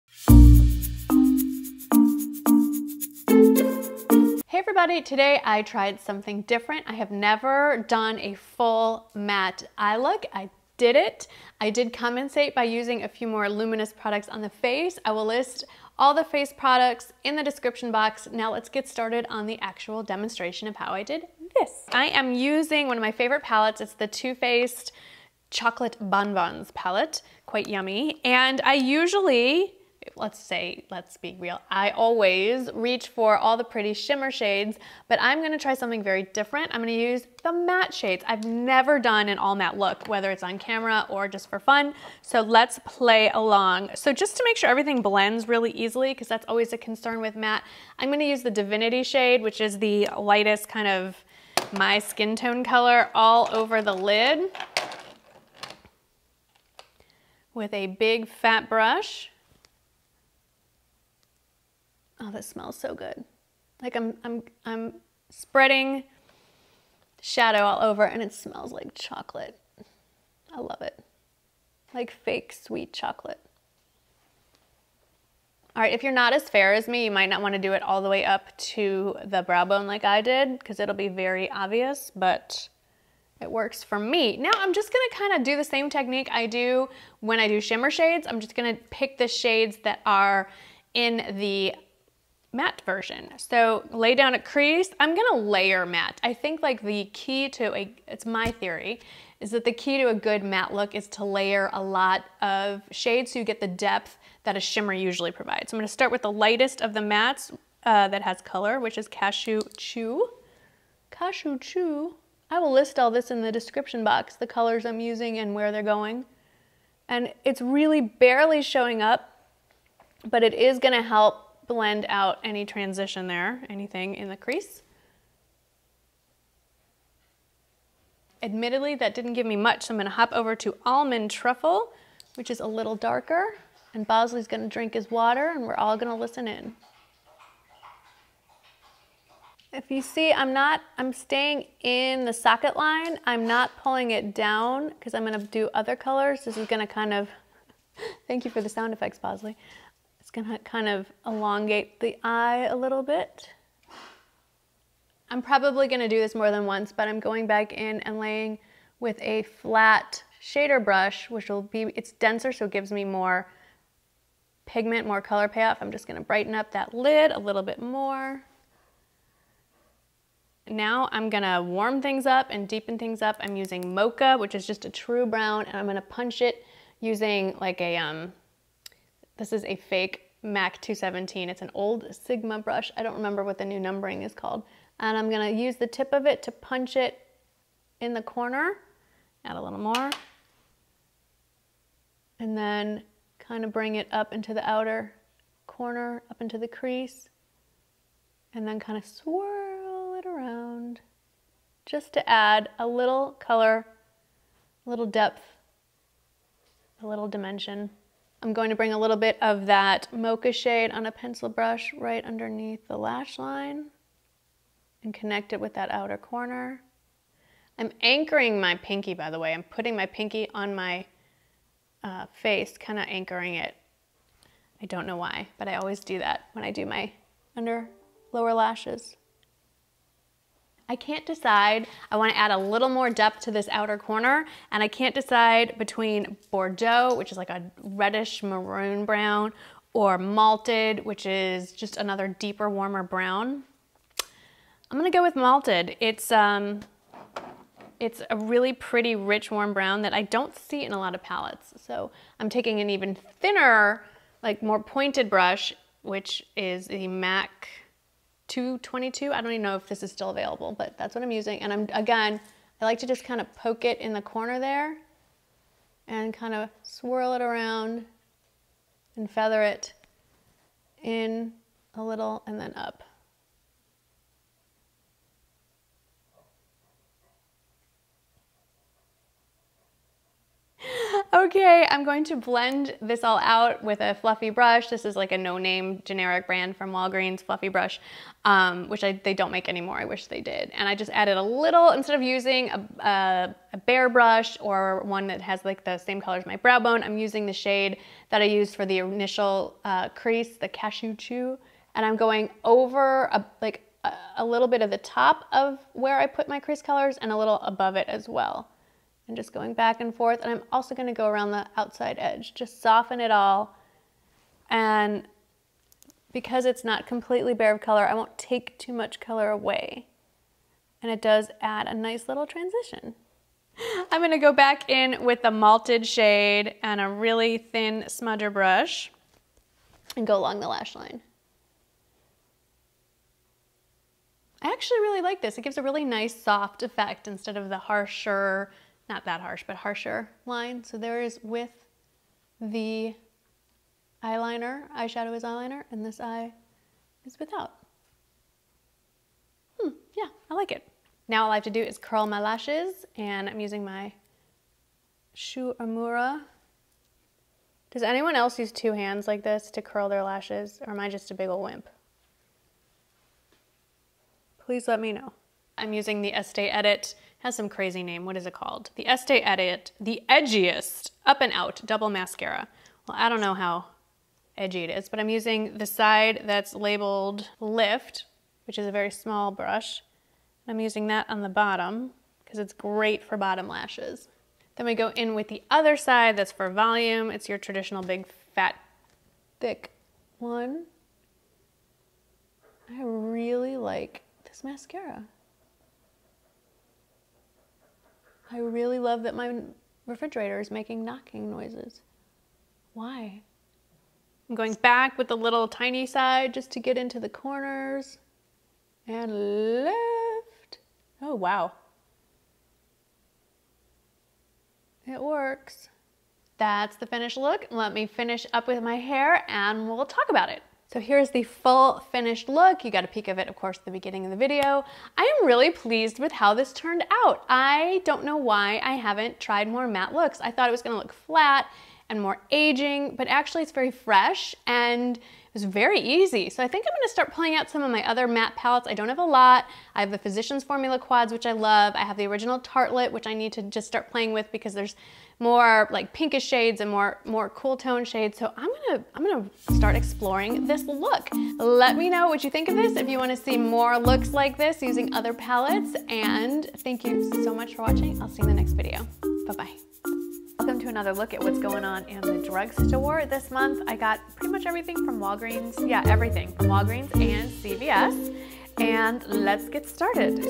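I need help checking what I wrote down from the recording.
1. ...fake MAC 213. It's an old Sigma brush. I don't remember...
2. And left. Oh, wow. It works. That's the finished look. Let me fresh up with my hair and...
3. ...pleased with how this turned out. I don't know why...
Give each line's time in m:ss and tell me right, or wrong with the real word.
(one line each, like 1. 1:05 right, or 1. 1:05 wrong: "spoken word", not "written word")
1. 2:59 wrong: "217", not "213"
2. 6:49 wrong: "finish", not "fresh"
3. 7:05 right.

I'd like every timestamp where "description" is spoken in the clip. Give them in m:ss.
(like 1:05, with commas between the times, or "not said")
0:17, 1:53.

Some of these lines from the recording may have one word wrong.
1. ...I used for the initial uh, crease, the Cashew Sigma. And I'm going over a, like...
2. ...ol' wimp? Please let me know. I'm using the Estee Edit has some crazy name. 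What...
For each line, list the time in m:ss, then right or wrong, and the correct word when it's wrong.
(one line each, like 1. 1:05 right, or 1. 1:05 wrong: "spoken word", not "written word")
1. 4:58 wrong: "Chew", not "Sigma"
2. 6:01 right.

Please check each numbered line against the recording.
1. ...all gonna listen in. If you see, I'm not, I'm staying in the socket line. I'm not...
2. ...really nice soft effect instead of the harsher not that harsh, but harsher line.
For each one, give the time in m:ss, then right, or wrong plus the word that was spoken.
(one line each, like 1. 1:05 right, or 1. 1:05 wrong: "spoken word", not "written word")
1. 2:15 right
2. 5:35 right.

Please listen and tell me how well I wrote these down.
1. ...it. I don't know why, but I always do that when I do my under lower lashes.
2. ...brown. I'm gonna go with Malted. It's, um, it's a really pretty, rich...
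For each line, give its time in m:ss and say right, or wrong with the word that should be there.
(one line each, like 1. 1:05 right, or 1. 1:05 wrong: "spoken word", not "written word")
1. 3:43 right
2. 4:03 right.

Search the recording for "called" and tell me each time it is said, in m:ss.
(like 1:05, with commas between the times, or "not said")
3:04, 6:08.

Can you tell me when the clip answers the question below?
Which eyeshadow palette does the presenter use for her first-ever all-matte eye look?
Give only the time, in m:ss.
0:24.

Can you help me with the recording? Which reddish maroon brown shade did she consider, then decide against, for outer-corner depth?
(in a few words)
Bordeaux.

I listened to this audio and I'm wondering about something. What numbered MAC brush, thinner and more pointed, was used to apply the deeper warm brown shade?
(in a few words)
MAC 222.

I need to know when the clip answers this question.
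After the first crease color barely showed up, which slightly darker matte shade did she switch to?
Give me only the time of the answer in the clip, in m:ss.
2:10.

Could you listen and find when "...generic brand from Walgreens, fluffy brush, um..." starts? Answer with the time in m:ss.
4:46.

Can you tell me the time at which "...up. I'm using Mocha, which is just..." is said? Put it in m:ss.
2:53.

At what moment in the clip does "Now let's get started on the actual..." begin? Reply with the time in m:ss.
0:18.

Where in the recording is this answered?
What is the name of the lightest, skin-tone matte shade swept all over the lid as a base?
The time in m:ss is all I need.
0:48.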